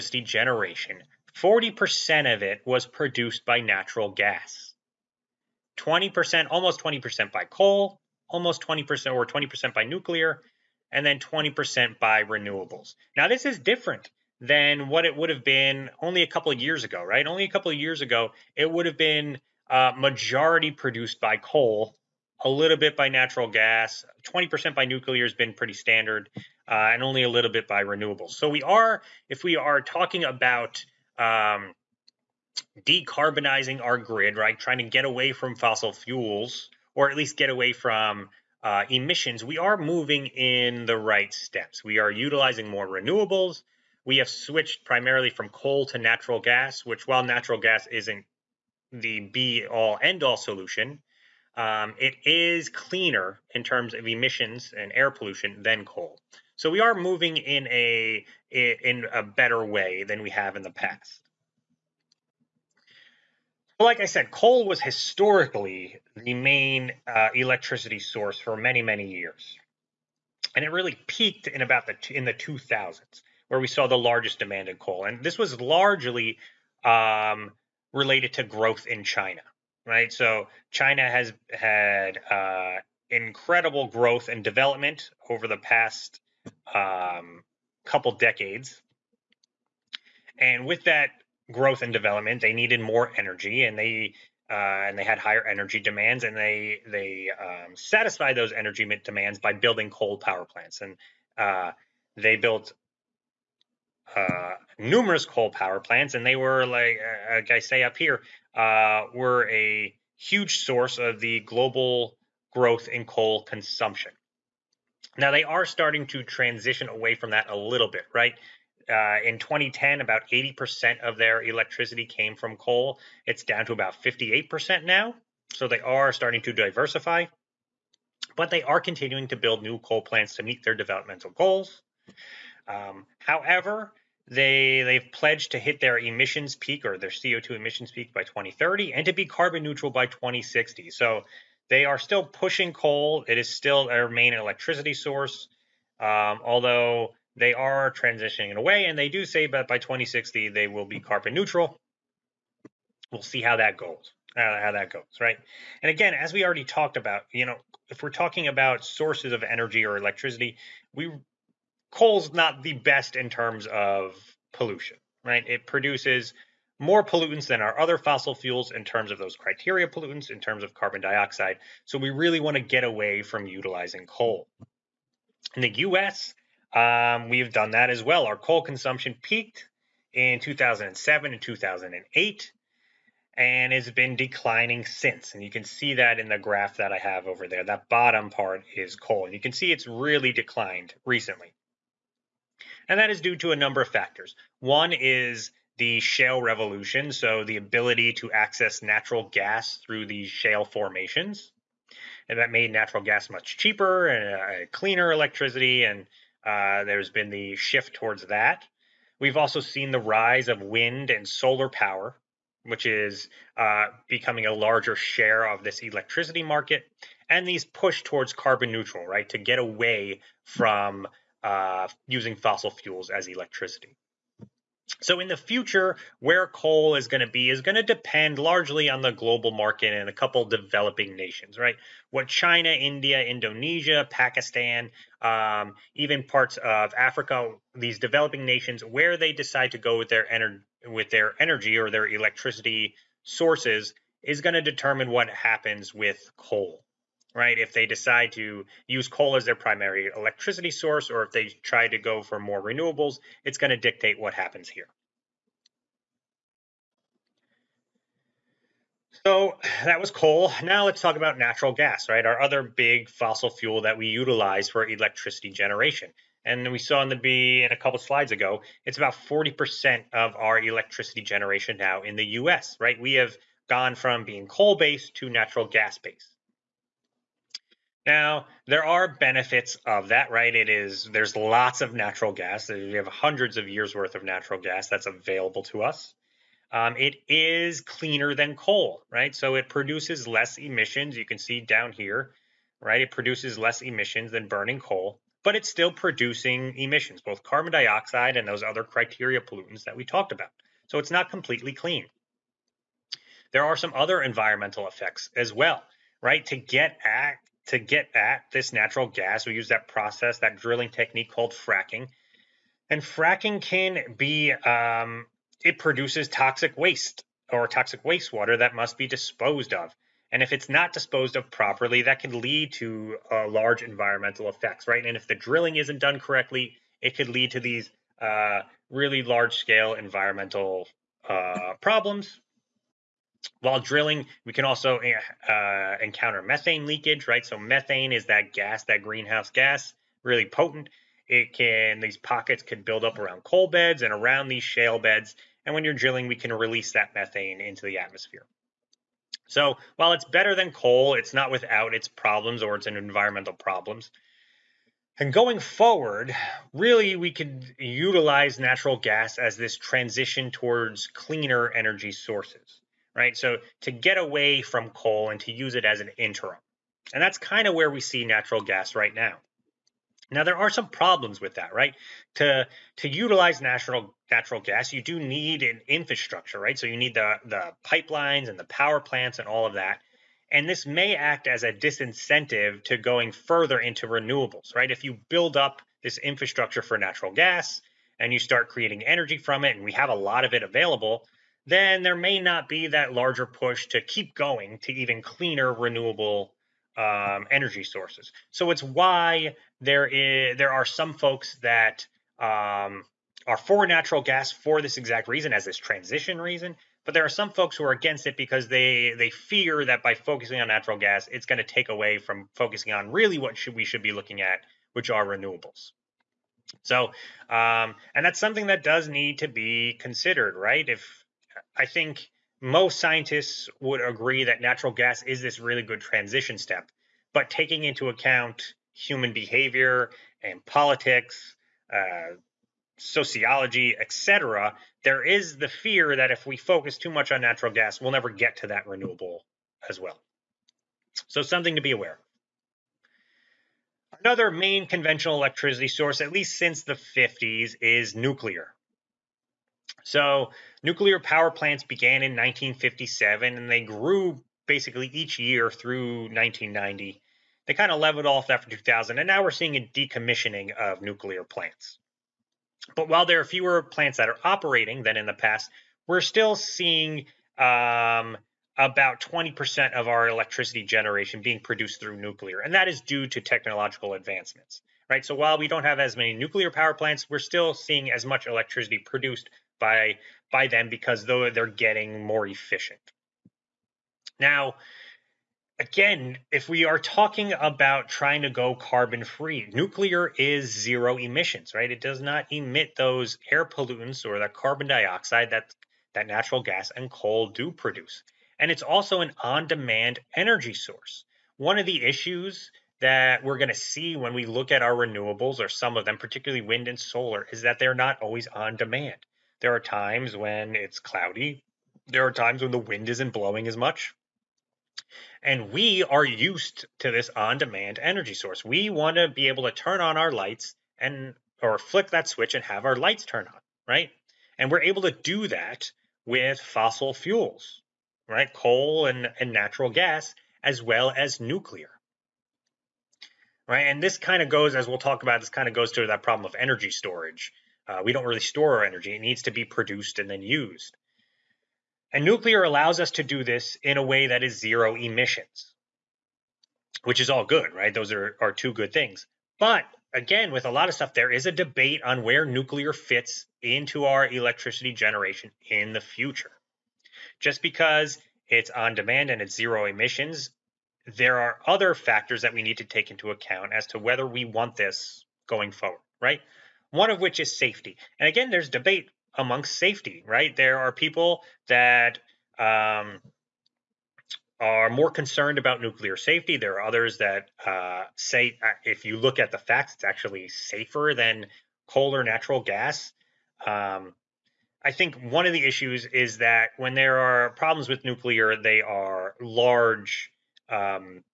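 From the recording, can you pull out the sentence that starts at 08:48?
Coal and, and natural gas, as well as nuclear.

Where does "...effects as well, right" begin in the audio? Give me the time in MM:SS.
05:04.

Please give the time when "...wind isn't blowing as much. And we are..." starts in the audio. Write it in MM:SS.
08:32.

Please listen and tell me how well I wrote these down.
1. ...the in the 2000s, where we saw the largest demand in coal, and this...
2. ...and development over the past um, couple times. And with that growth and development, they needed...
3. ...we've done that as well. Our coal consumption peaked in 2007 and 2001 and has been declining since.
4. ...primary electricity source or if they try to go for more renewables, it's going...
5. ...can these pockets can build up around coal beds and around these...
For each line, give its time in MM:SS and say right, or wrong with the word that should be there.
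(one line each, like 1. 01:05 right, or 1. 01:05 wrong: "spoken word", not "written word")
1. 01:11 right
2. 01:24 wrong: "decades", not "times"
3. 02:57 wrong: "2008", not "2001"
4. 04:09 right
5. 05:41 right.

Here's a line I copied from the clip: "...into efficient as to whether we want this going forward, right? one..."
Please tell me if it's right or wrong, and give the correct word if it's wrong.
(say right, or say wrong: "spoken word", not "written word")
wrong: "account", not "efficient".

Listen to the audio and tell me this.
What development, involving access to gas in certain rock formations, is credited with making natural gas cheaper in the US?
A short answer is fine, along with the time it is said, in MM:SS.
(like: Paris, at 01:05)
shale revolution, at 03:16.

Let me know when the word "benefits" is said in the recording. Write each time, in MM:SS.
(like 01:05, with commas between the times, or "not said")
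04:39.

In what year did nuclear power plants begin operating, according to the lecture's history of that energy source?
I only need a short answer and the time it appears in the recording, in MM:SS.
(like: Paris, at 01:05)
1957, at 07:32.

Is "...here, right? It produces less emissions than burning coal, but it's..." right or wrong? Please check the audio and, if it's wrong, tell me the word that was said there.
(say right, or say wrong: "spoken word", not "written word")
right.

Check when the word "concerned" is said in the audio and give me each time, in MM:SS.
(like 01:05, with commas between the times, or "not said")
09:35.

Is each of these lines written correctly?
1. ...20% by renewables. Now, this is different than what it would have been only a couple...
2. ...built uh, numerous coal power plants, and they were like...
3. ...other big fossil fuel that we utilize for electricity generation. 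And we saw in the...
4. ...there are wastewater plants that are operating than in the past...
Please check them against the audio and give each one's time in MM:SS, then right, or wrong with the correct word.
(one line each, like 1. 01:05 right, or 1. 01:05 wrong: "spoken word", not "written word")
1. 00:11 right
2. 01:42 right
3. 04:22 right
4. 07:43 wrong: "fewer", not "wastewater".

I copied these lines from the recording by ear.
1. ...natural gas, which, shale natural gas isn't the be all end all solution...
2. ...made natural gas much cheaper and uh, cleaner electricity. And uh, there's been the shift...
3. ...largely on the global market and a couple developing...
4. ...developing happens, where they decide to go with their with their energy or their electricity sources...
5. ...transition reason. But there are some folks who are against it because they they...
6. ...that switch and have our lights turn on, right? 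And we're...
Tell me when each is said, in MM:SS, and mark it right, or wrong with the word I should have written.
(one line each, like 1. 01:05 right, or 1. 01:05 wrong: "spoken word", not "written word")
1. 00:45 wrong: "while", not "shale"
2. 03:22 right
3. 03:48 right
4. 03:57 wrong: "nations", not "happens"
5. 06:45 right
6. 08:42 right.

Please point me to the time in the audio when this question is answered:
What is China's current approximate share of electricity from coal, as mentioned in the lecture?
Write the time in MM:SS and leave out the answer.
02:04.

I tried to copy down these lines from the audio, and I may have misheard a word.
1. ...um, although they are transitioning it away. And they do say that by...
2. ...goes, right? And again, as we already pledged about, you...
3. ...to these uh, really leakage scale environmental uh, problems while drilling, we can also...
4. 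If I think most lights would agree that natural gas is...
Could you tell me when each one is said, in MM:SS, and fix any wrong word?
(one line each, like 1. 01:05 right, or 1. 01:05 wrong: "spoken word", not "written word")
1. 02:25 right
2. 02:34 wrong: "talked", not "pledged"
3. 05:27 wrong: "large", not "leakage"
4. 07:00 wrong: "scientists", not "lights".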